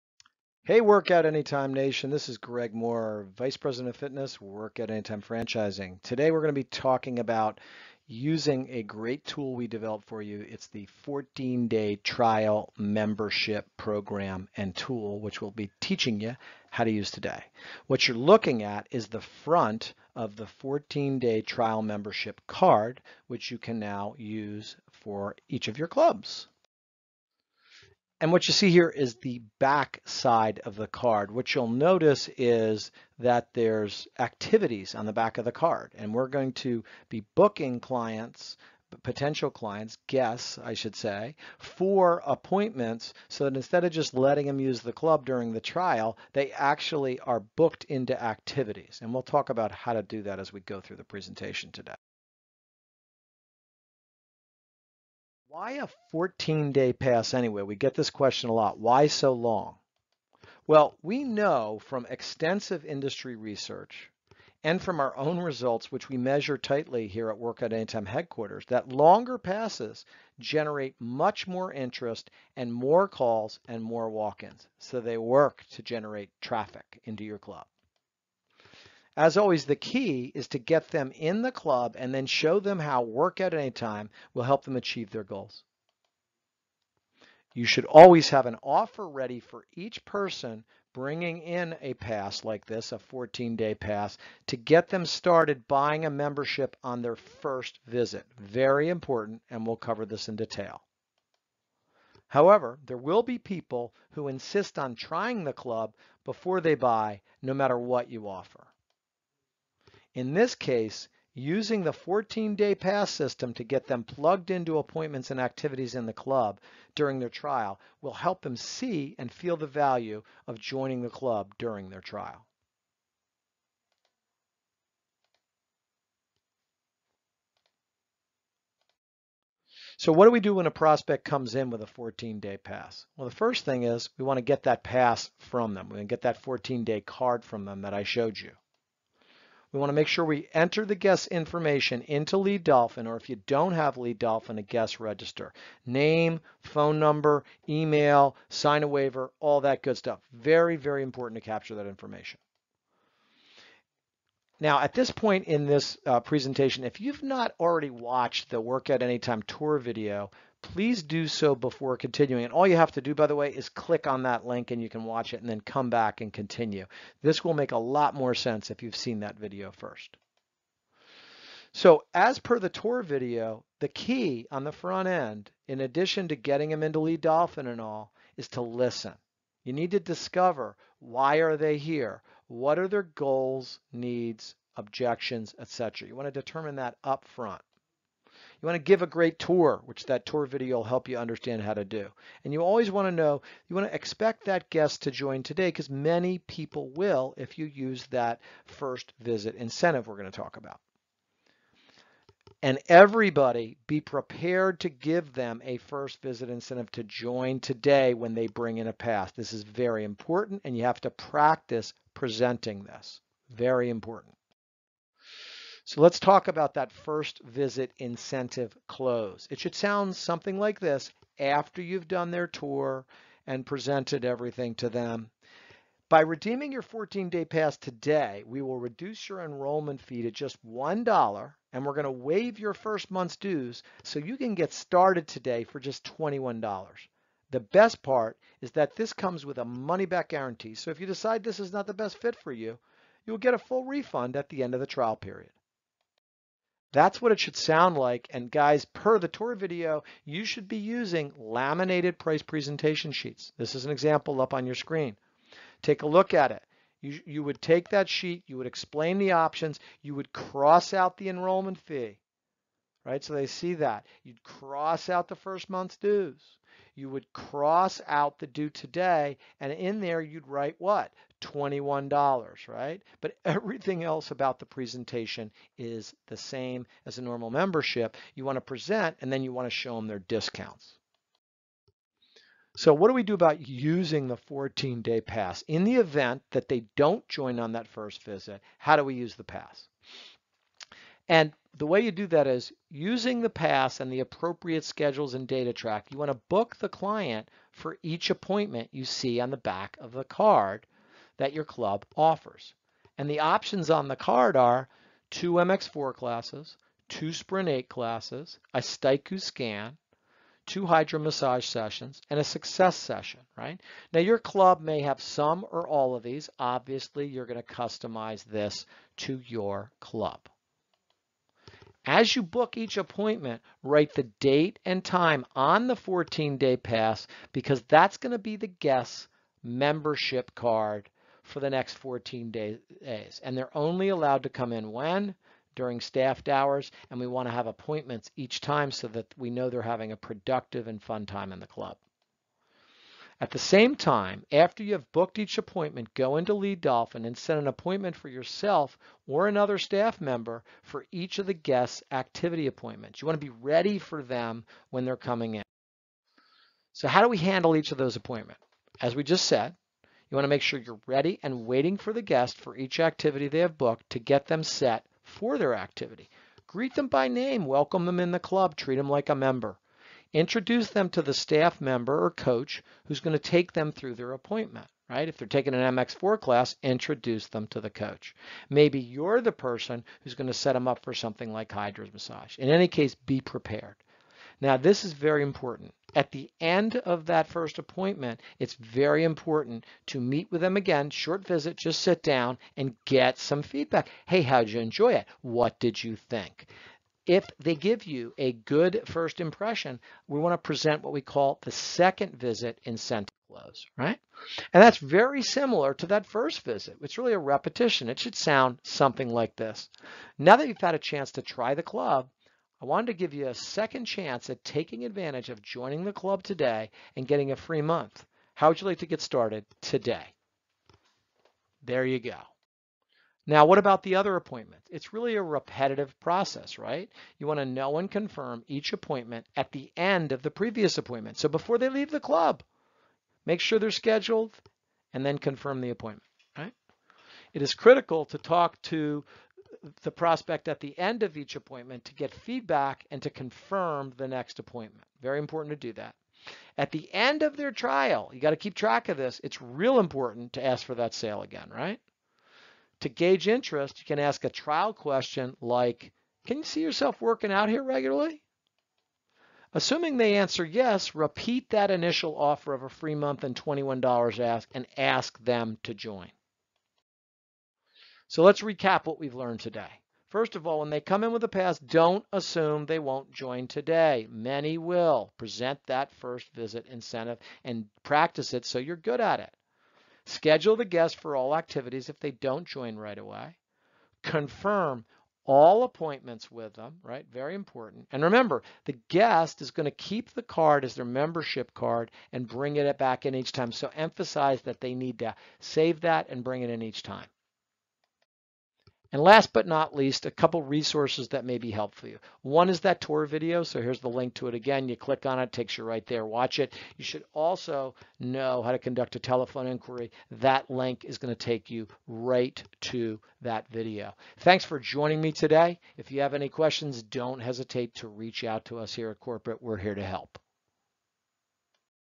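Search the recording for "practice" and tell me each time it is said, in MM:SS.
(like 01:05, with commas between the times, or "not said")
03:31, 07:58.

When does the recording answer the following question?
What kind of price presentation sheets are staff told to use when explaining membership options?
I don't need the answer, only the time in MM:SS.
04:11.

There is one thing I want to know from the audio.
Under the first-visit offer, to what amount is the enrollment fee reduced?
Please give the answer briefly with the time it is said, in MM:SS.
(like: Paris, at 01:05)
$1, at 03:50.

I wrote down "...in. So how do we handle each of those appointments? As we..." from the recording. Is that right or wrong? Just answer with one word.
right.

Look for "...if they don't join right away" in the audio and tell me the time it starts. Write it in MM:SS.
08:02.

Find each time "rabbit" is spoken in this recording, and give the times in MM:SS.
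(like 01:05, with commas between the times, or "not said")
not said.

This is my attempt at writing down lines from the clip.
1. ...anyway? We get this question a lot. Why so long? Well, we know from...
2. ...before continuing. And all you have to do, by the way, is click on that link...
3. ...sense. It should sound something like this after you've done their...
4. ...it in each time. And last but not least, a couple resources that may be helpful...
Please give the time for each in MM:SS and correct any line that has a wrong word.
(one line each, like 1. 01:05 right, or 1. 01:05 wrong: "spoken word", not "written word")
1. 00:57 right
2. 02:41 right
3. 03:38 wrong: "close", not "sense"
4. 08:16 right.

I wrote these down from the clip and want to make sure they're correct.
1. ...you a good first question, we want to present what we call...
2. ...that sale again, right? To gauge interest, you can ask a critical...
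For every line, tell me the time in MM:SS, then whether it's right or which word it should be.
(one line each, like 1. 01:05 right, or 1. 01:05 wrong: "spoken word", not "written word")
1. 06:38 wrong: "impression", not "question"
2. 07:30 wrong: "trial", not "critical".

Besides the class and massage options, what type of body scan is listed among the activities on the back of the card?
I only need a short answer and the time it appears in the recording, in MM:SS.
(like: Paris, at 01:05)
Styku scan, at 05:08.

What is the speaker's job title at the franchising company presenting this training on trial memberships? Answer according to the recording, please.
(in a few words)
Vice President of Fitness.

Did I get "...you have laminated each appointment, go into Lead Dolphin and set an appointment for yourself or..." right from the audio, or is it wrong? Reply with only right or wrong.
wrong.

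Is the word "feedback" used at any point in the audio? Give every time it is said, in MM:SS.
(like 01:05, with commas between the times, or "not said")
06:33, 07:22.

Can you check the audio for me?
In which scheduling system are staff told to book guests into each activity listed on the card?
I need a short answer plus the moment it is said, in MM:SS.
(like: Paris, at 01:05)
DataTrak, at 04:55.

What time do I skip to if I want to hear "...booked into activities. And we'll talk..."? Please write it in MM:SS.
00:47.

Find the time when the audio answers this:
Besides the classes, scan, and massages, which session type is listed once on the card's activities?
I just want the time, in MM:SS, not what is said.
05:12.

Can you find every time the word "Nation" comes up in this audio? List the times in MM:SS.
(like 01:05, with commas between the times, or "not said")
00:01.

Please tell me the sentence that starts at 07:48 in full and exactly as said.
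So let's recap what we've learned today.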